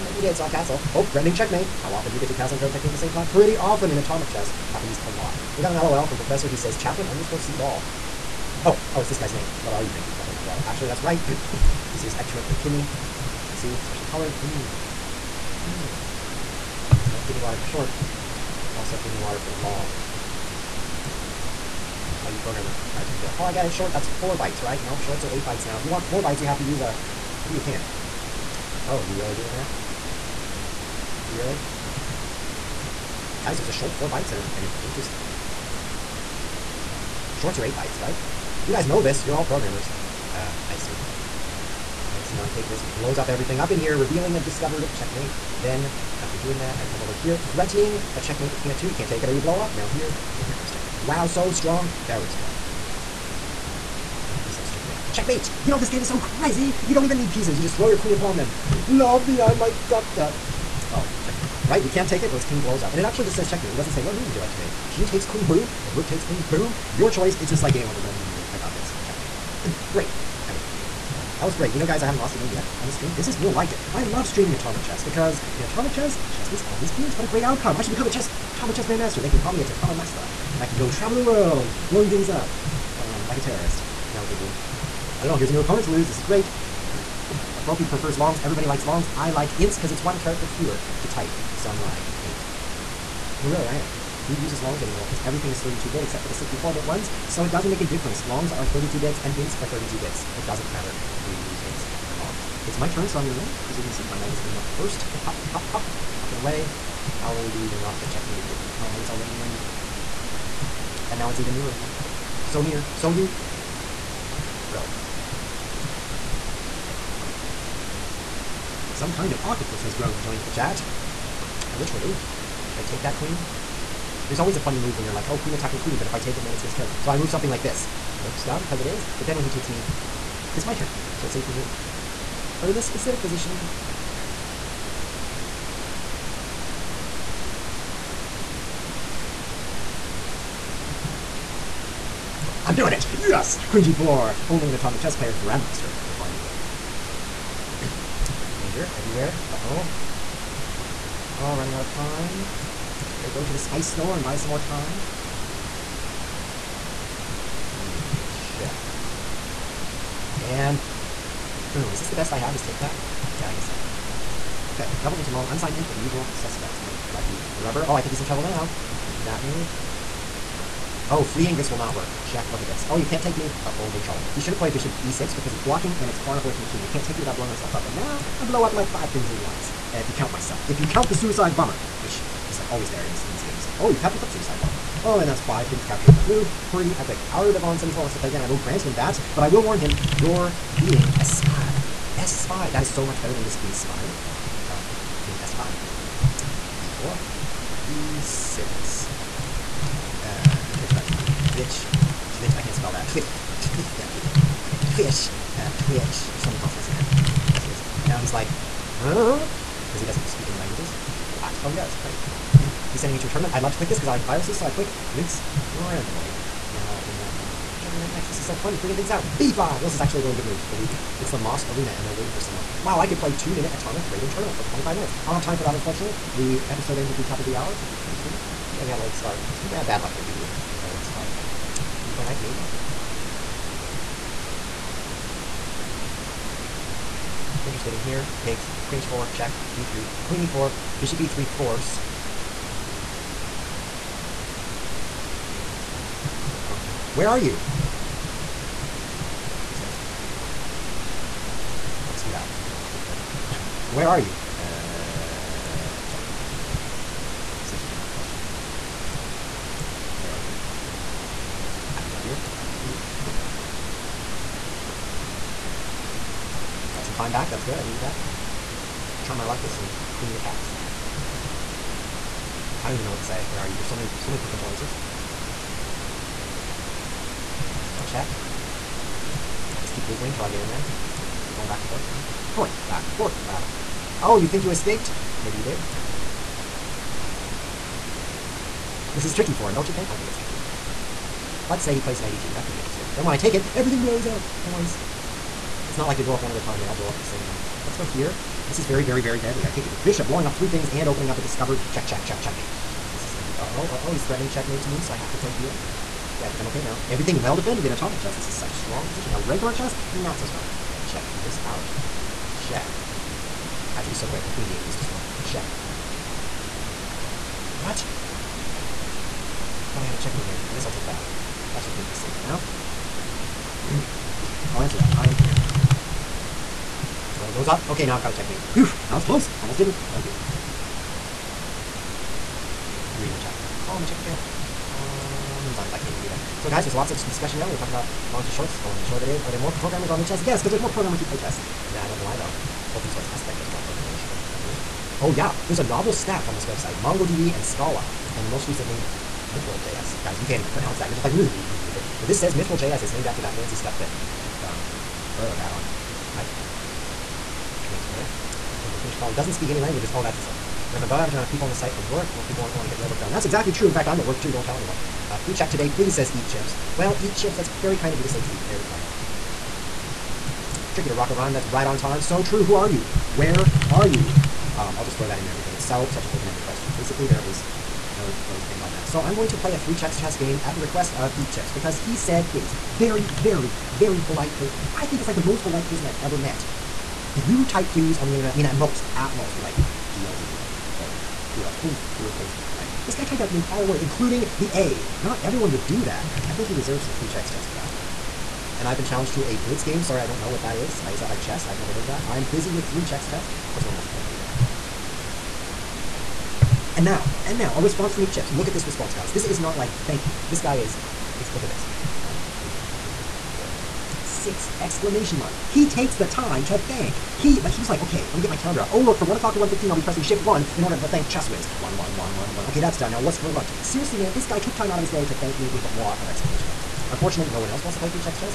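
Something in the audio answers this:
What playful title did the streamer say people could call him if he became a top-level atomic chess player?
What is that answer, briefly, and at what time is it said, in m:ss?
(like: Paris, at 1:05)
Tatama Master, at 1:19.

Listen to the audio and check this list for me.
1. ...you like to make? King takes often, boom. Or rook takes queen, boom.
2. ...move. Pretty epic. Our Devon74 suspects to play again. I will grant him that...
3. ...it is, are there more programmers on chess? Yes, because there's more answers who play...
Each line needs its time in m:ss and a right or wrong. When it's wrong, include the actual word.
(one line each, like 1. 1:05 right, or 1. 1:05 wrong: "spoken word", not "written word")
1. 1:04 wrong: "queen", not "often"
2. 3:06 wrong: "wants", not "suspects"
3. 5:39 wrong: "programmers", not "answers".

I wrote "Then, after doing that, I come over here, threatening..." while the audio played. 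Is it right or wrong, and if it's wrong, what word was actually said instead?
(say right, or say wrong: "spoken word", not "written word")
right.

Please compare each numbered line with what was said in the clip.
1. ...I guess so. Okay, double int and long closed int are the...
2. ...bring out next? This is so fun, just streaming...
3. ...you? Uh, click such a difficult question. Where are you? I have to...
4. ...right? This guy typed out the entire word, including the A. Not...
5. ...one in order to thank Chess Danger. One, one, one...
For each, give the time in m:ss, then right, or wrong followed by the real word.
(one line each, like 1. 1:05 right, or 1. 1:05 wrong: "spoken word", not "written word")
1. 2:43 wrong: "unsigned", not "closed"
2. 3:37 wrong: "bringing", not "streaming"
3. 4:14 wrong: "check", not "click"
4. 6:32 right
5. 7:00 wrong: "Whiz", not "Danger".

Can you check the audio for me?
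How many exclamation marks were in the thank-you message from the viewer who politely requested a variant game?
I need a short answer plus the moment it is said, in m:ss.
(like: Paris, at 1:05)
6, at 6:54.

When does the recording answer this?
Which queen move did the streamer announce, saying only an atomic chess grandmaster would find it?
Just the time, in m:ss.
2:23.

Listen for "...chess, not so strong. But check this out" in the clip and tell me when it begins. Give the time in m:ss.
5:09.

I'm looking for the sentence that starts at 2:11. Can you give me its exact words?
So it saves me a move.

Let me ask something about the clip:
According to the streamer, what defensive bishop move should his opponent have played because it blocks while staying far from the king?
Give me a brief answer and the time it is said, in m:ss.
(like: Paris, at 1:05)
Bishop e6, at 2:54.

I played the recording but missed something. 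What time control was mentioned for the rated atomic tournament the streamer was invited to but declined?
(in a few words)
2 minutes.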